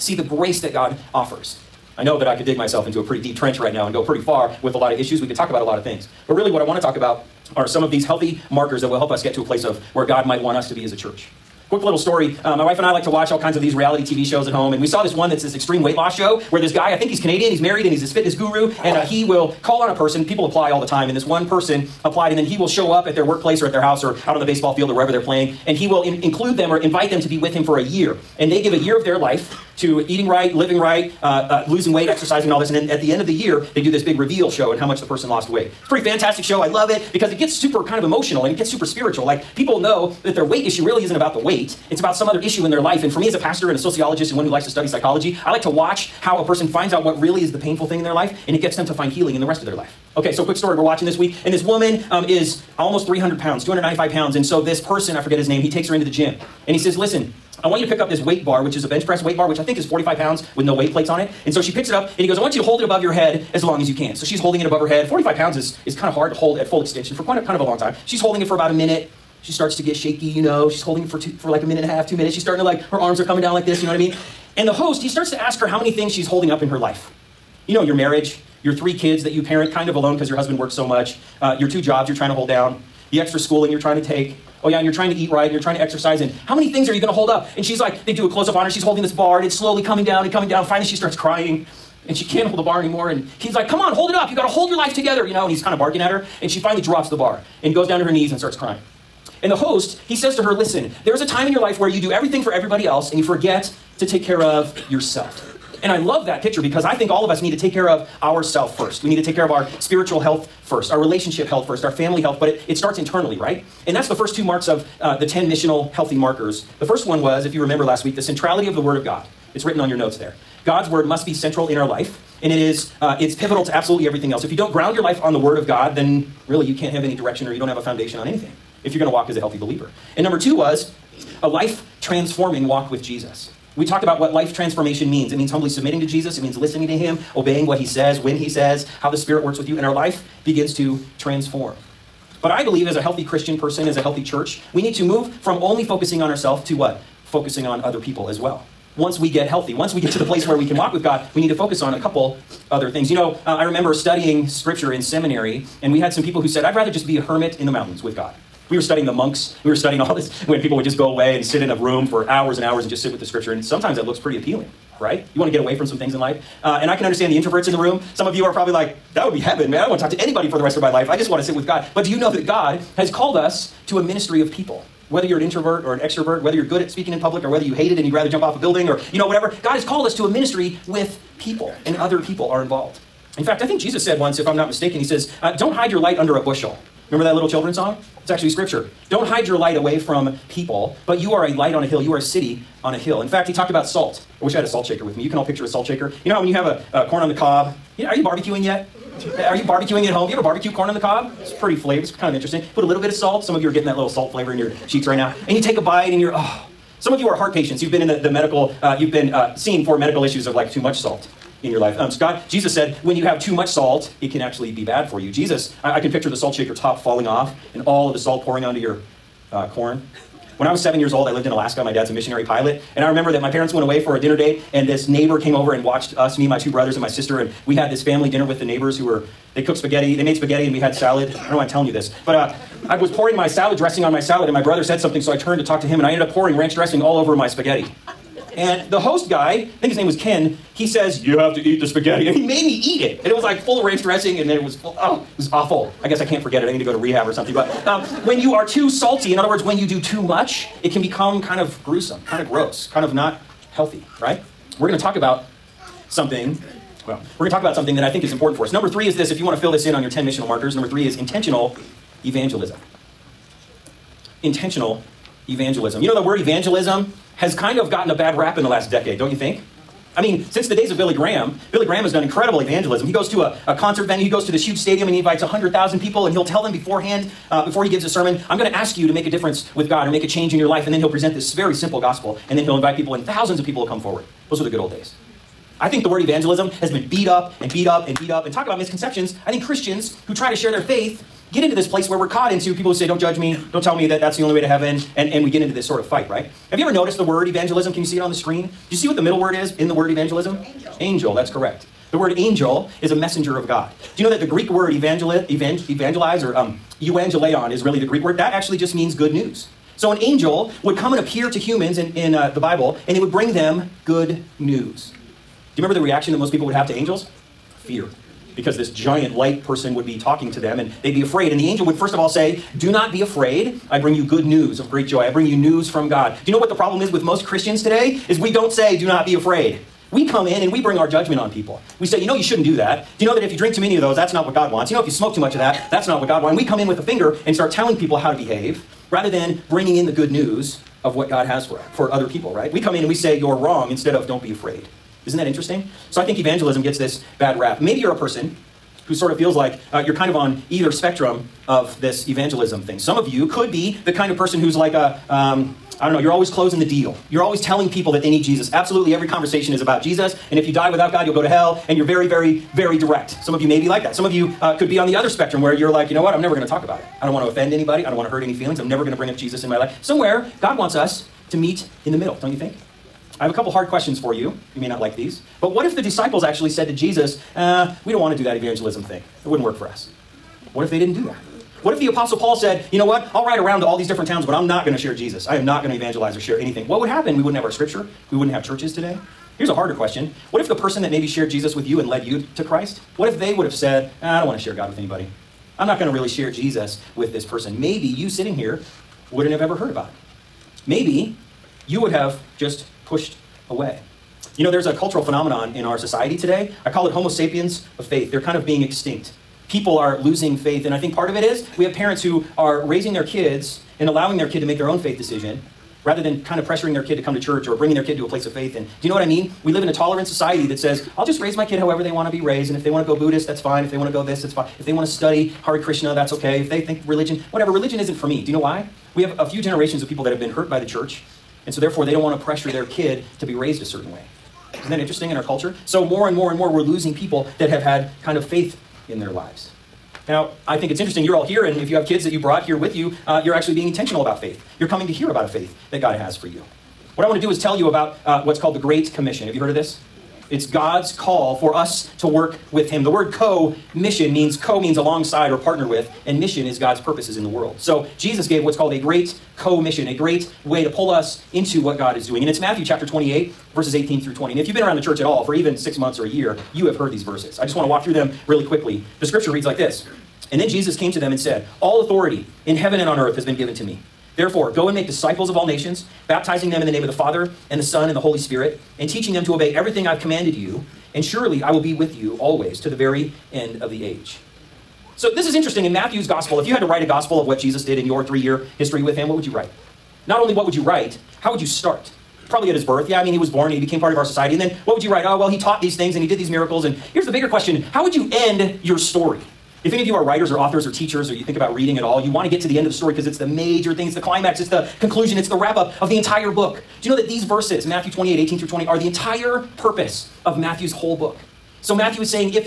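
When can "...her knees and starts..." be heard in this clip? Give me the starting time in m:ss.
1:38.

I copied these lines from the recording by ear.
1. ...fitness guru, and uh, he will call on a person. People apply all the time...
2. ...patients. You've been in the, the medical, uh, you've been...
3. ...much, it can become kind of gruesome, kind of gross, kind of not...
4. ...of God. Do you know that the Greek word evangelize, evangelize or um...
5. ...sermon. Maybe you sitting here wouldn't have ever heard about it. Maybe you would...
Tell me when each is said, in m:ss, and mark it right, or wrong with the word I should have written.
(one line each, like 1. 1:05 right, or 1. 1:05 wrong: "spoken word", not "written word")
1. 0:18 right
2. 3:27 right
3. 4:10 right
4. 5:03 right
5. 6:37 wrong: "person", not "sermon".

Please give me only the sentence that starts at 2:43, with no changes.
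And sometimes that looks pretty appealing right?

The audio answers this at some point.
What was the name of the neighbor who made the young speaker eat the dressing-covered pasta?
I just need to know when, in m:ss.
4:00.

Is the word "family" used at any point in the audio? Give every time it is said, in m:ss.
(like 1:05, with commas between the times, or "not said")
1:51, 3:48.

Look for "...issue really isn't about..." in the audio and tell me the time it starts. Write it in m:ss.
0:40.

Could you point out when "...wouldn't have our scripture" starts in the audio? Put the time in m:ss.
6:27.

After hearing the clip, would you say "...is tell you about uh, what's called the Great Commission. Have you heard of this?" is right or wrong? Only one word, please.
right.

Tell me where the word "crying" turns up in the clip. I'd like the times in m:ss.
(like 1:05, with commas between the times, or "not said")
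1:31, 1:38.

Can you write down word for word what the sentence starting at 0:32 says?
And then at the end of the year, they do this big reveal show and how much the person lost weight.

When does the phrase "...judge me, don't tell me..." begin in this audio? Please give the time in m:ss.
4:53.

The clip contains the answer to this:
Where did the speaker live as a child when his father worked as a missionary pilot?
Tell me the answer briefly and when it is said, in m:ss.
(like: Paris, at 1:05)
Alaska, at 3:41.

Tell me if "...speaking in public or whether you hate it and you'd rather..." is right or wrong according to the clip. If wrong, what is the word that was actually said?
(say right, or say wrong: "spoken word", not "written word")
right.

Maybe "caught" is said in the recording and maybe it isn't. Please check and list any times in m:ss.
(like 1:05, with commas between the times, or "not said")
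4:52.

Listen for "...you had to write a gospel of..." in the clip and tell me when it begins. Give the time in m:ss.
8:06.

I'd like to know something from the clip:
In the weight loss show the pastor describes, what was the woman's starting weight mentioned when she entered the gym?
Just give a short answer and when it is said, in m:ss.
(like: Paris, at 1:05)
295 pounds, at 0:53.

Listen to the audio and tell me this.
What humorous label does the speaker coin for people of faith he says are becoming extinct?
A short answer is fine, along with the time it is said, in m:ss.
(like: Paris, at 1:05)
Homo sapiens of faith, at 6:47.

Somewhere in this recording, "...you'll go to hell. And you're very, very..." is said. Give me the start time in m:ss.
6:01.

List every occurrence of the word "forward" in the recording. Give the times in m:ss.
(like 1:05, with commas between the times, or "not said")
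4:43.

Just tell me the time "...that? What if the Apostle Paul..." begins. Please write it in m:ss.
6:21.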